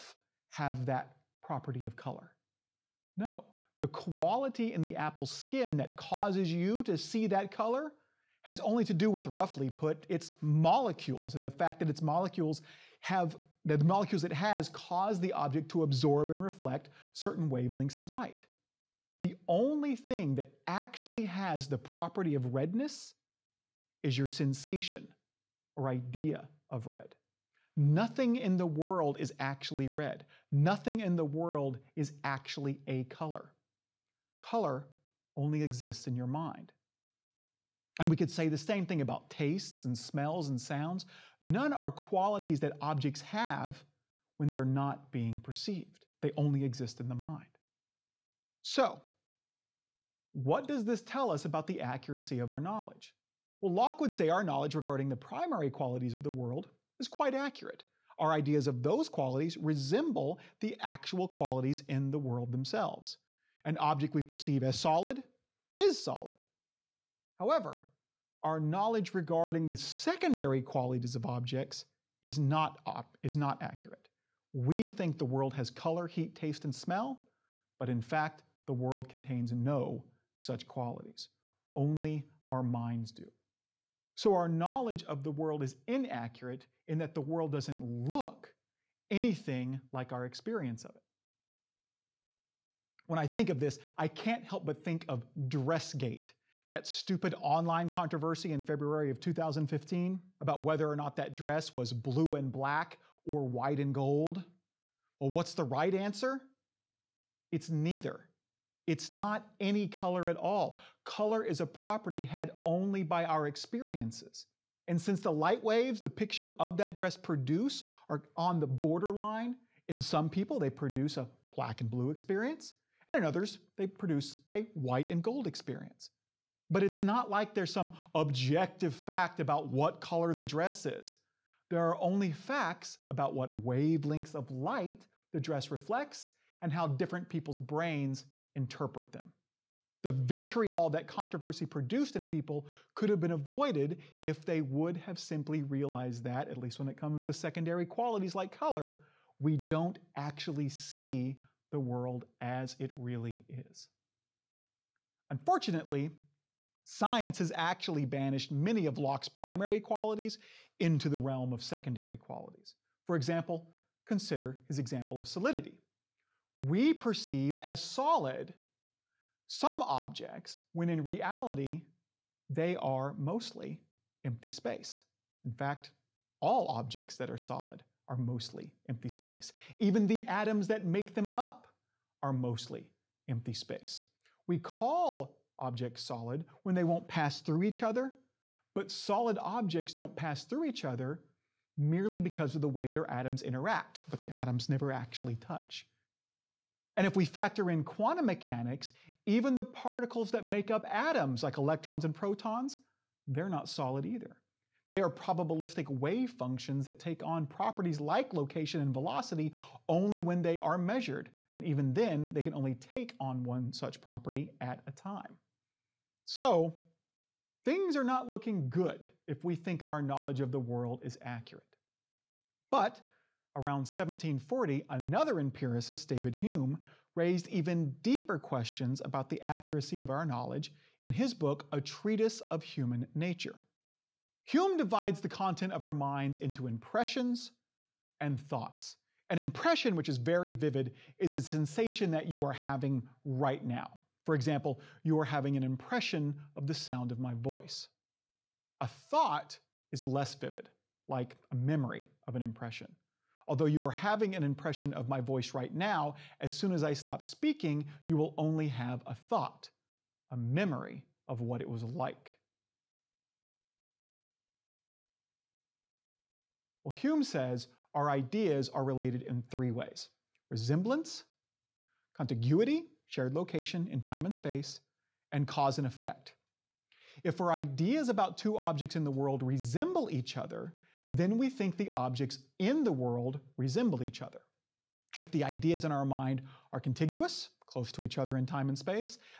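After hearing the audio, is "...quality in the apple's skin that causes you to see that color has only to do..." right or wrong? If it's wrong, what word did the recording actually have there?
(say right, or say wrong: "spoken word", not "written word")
right.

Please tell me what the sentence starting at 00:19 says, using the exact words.
The only thing that actually has the property of redness is your sensation or idea of red.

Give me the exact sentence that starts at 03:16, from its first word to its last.
And if we factor in quantum mechanics, even the particles that make up atoms, like electrons and protons, they're not solid either.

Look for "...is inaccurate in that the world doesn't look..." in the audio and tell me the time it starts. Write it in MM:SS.
01:25.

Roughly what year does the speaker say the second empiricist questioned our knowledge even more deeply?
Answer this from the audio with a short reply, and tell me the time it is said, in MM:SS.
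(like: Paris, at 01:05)
1740, at 03:43.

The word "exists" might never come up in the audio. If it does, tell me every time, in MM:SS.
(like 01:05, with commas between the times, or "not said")
00:35, 00:46.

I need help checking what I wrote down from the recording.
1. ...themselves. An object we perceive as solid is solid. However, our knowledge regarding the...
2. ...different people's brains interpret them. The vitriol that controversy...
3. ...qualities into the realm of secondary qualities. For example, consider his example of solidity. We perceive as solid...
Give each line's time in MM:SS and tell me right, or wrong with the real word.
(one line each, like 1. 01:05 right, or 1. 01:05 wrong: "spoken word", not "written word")
1. 01:02 right
2. 02:16 right
3. 02:39 right.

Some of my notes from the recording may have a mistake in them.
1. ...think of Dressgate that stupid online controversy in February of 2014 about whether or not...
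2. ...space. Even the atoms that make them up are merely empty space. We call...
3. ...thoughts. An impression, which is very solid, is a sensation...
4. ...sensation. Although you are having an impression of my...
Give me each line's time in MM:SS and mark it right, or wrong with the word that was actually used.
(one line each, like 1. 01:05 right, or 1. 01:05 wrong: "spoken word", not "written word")
1. 01:34 wrong: "2015", not "2014"
2. 02:59 wrong: "mostly", not "merely"
3. 03:58 wrong: "vivid", not "solid"
4. 04:12 wrong: "impression", not "sensation".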